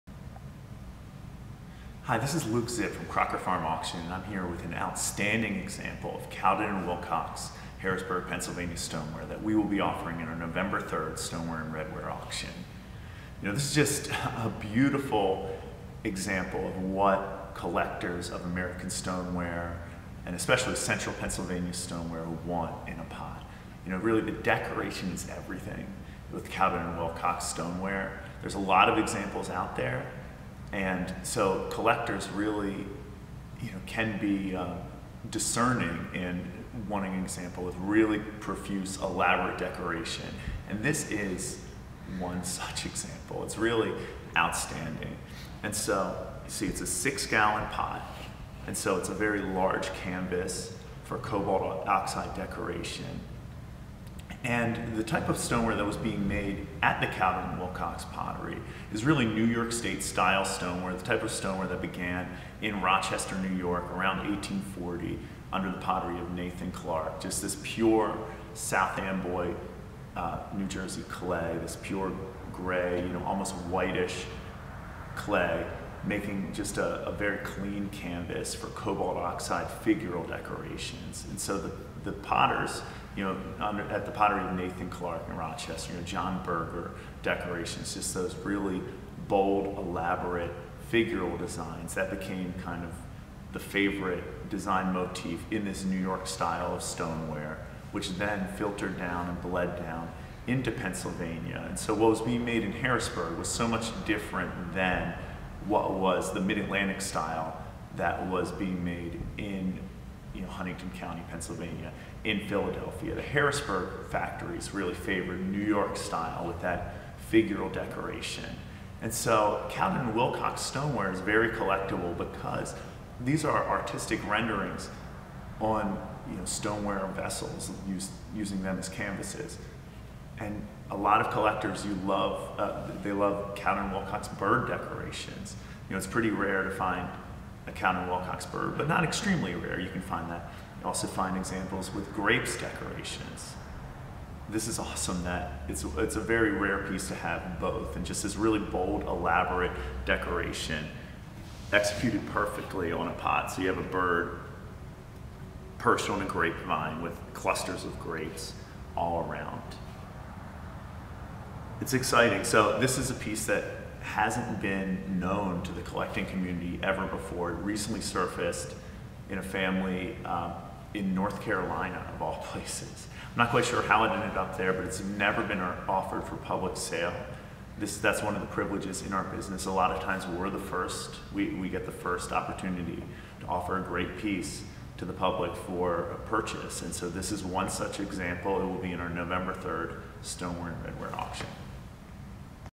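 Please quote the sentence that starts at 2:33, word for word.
So you have a bird perched on a grapevine with clusters of grapes all around.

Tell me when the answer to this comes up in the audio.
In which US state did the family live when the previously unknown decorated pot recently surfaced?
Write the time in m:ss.
2:51.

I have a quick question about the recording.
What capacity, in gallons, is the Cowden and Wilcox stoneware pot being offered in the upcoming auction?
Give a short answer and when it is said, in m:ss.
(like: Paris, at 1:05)
6 gallon, at 0:46.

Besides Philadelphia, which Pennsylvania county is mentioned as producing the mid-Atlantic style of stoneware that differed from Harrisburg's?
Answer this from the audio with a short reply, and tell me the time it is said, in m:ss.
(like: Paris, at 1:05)
Huntingdon County, at 1:50.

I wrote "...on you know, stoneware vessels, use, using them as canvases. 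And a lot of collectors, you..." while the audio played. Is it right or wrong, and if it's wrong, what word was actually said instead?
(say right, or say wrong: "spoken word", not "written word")
right.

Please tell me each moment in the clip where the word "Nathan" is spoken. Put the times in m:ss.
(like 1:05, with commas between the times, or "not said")
1:06, 1:24.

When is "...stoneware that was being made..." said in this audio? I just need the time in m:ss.
0:55.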